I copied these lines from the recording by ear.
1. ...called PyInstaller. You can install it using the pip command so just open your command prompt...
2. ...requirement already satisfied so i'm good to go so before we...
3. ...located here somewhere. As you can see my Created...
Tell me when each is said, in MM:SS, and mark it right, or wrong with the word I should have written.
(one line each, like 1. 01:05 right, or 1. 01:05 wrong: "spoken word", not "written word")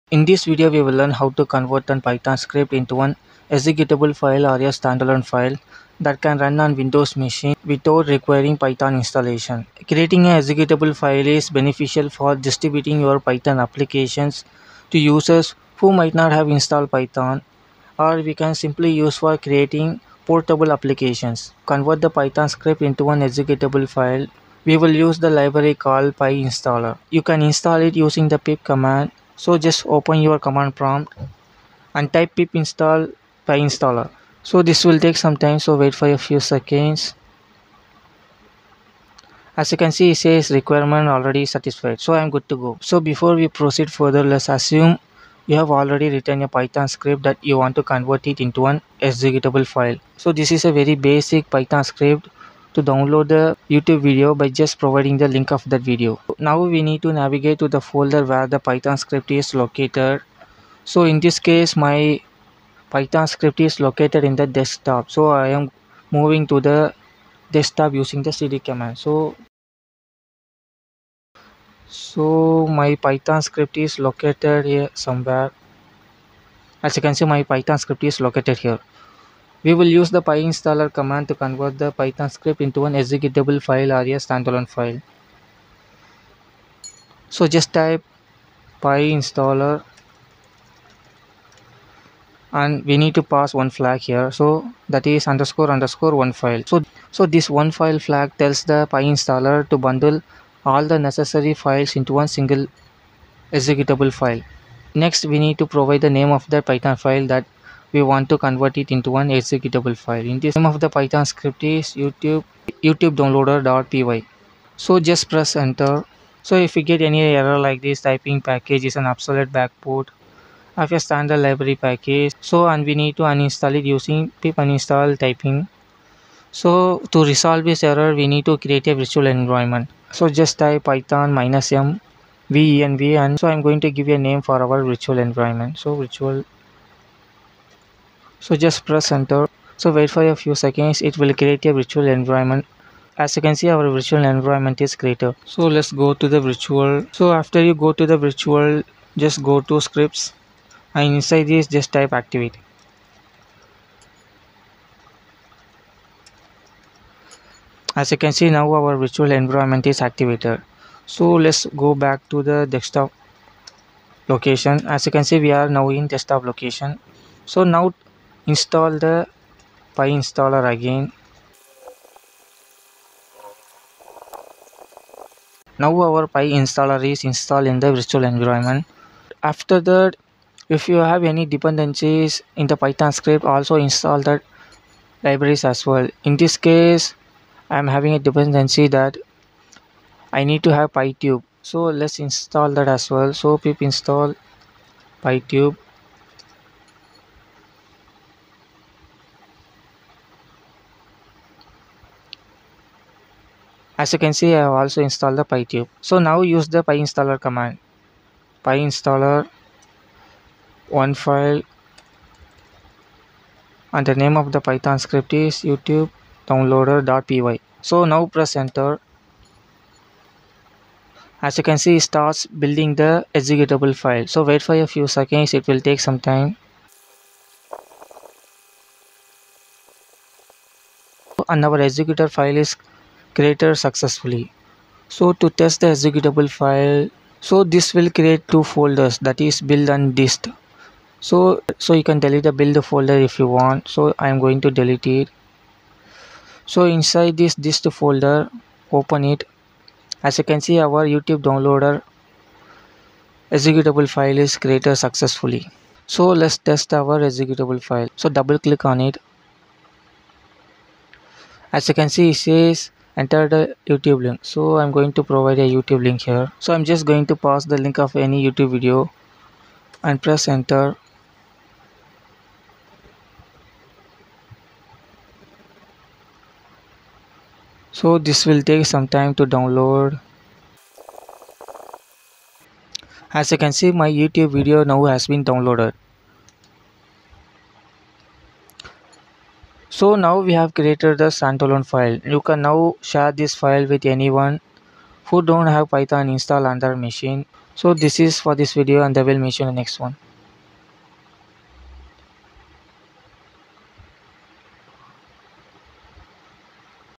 1. 00:25 right
2. 00:40 right
3. 01:13 wrong: "Python", not "Created".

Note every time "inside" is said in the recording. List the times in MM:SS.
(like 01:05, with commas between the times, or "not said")
02:31, 04:06.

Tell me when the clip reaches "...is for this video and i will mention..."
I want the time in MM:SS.
04:58.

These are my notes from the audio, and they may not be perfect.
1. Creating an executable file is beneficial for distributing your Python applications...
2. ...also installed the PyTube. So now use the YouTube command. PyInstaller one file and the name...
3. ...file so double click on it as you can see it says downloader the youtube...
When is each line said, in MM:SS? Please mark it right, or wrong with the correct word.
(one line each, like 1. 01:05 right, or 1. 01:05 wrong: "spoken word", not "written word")
1. 00:09 right
2. 03:24 wrong: "PyInstaller", not "YouTube"
3. 04:17 wrong: "enter", not "downloader".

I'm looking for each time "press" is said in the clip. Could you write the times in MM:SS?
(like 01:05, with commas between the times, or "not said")
01:55, 02:18, 03:38, 04:30.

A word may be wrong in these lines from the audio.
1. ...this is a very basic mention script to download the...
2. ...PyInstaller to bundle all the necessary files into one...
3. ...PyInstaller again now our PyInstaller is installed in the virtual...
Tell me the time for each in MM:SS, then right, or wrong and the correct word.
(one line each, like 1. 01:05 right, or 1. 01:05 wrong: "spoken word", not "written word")
1. 00:50 wrong: "python", not "mention"
2. 01:38 right
3. 02:49 right.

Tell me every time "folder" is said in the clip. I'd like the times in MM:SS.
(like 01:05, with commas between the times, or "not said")
00:57, 03:58, 04:02, 04:07.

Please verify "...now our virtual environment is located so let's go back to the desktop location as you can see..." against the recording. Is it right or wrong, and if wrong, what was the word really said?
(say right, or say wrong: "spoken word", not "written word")
wrong: "activated", not "located".